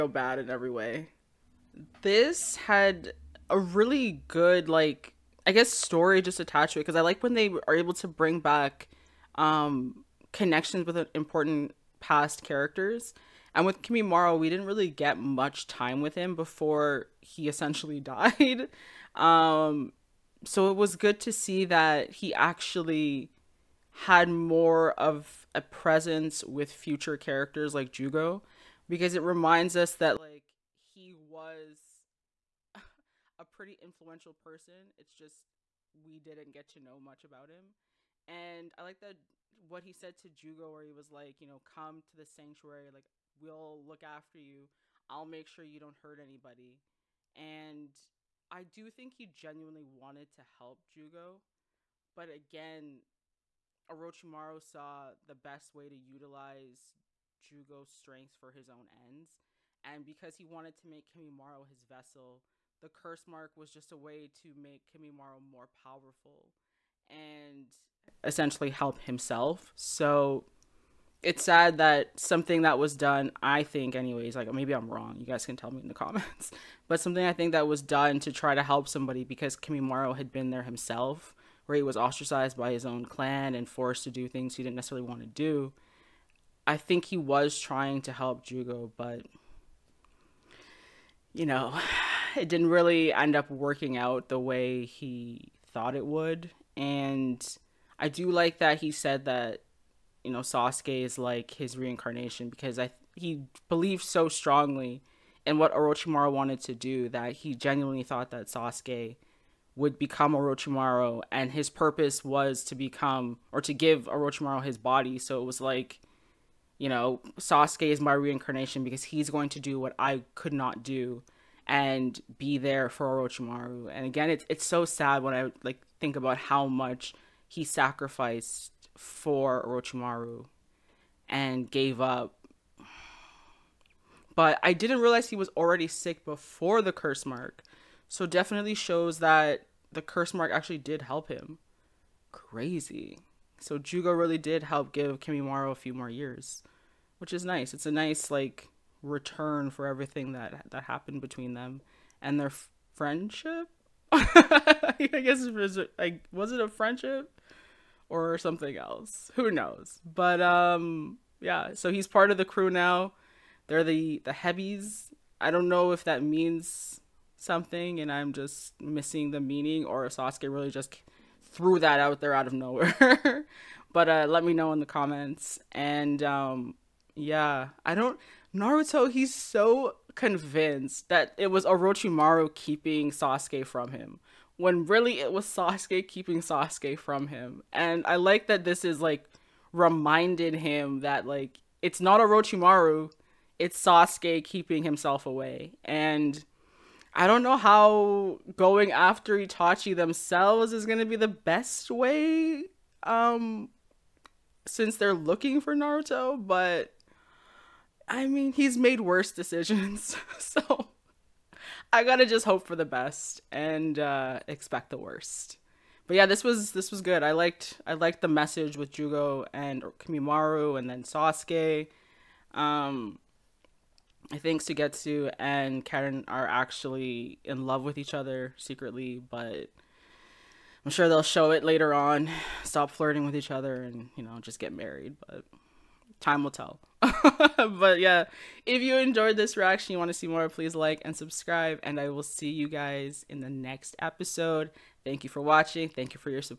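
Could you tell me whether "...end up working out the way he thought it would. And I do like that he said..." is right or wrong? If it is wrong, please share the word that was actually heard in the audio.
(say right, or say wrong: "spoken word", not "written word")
right.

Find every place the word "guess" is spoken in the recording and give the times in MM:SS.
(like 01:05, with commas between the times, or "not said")
00:05, 02:35.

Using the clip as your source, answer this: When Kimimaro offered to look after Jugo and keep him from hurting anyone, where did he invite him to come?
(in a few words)
The sanctuary.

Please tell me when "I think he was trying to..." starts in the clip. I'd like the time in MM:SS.
01:26.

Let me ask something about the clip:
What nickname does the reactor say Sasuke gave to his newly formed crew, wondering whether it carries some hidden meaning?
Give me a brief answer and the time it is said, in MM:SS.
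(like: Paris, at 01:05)
The Heavies, at 02:44.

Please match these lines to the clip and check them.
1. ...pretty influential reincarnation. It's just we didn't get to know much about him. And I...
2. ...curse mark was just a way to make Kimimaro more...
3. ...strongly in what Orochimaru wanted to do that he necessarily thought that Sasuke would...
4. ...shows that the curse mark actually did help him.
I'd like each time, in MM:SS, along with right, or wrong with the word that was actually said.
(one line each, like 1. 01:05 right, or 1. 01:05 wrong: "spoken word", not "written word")
1. 00:33 wrong: "person", not "reincarnation"
2. 01:02 right
3. 01:44 wrong: "genuinely", not "necessarily"
4. 02:18 right.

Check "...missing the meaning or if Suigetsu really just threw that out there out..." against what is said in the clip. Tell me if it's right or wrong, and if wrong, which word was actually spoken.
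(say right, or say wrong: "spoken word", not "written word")
wrong: "Sasuke", not "Suigetsu".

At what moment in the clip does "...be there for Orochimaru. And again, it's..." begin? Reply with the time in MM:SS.
02:02.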